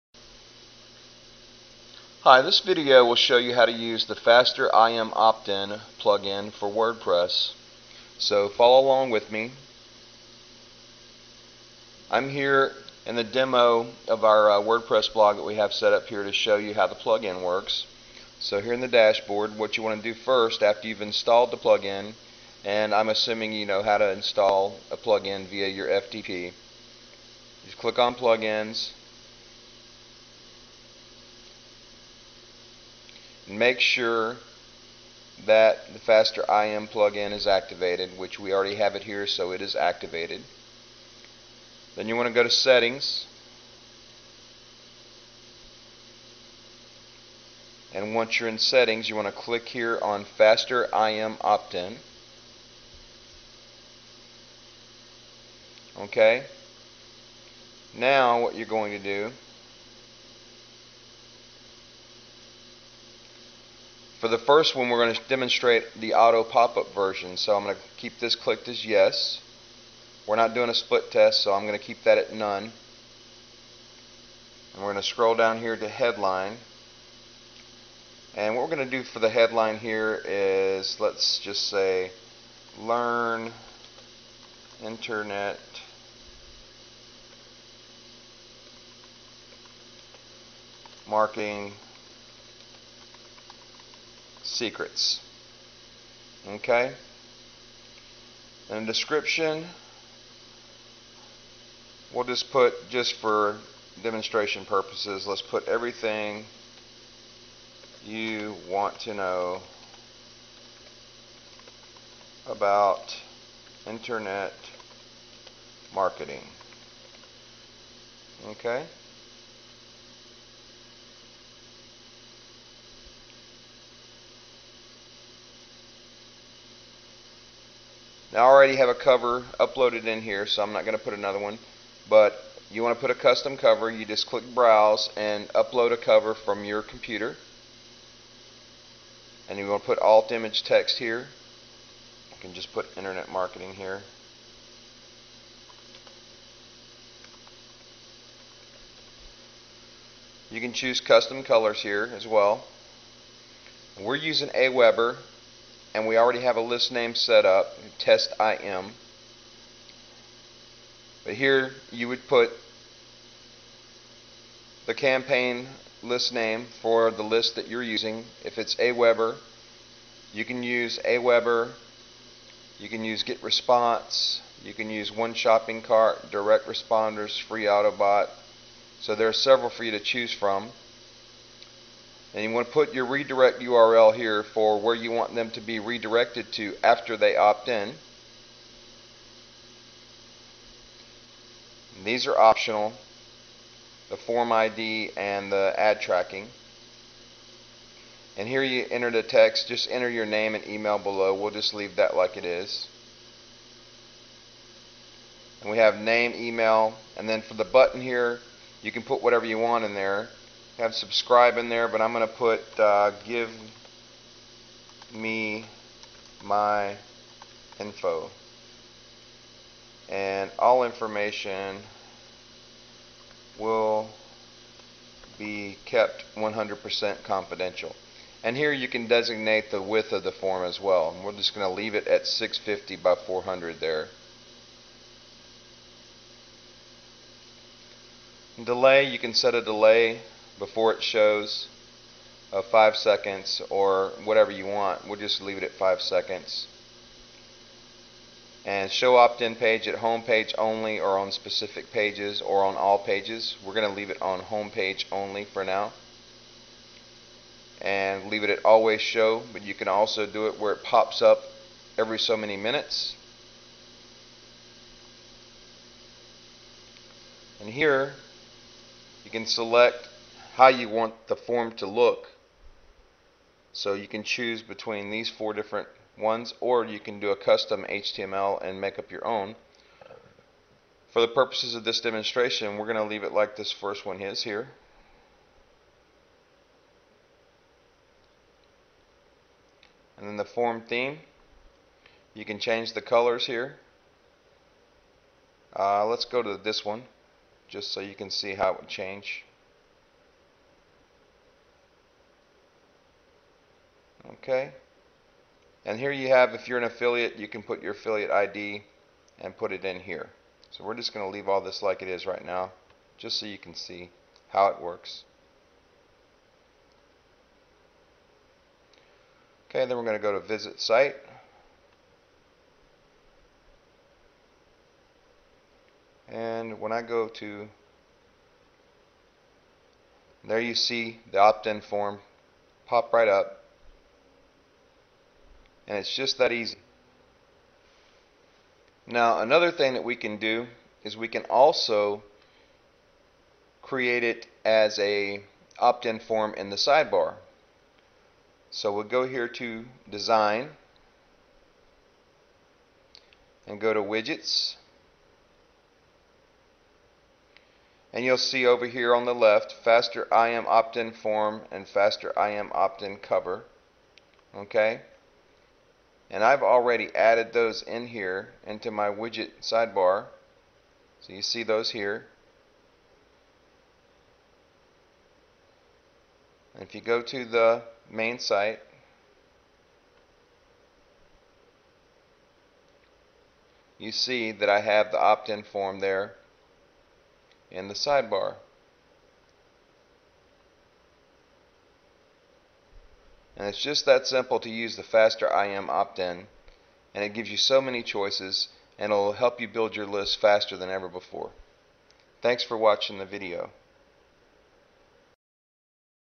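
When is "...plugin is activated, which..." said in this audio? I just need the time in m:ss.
0:36.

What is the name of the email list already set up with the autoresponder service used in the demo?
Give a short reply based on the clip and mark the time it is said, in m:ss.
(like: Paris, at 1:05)
test IM, at 2:37.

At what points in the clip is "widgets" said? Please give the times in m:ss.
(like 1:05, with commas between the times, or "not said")
5:54, 6:09.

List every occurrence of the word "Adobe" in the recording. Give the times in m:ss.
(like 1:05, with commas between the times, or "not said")
not said.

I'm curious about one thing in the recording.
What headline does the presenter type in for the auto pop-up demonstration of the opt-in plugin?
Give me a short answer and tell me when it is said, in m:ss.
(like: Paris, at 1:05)
Learn internet marketing secrets, at 1:22.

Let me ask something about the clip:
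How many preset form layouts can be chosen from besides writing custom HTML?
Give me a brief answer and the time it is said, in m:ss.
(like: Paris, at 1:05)
4, at 4:35.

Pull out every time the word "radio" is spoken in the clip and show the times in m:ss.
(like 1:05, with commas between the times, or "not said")
not said.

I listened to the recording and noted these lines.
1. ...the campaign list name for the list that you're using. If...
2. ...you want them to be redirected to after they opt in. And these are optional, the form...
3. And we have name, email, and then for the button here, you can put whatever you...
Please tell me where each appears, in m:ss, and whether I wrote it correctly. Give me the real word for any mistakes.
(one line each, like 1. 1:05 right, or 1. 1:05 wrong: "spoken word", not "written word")
1. 2:44 right
2. 3:04 right
3. 3:25 right.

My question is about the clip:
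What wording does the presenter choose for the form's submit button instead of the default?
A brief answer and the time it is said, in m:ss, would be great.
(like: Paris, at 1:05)
Give me my info, at 3:33.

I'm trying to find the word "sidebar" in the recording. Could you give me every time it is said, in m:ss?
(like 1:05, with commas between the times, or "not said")
5:46, 6:09, 6:27.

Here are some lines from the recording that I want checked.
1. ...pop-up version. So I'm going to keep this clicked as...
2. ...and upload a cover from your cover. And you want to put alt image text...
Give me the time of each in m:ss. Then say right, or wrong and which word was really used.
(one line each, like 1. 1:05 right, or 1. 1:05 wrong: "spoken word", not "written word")
1. 1:06 right
2. 2:15 wrong: "computer", not "cover".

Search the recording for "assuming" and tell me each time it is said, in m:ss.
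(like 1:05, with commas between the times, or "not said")
0:23.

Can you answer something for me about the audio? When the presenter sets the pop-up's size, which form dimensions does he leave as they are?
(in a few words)
650 by 400.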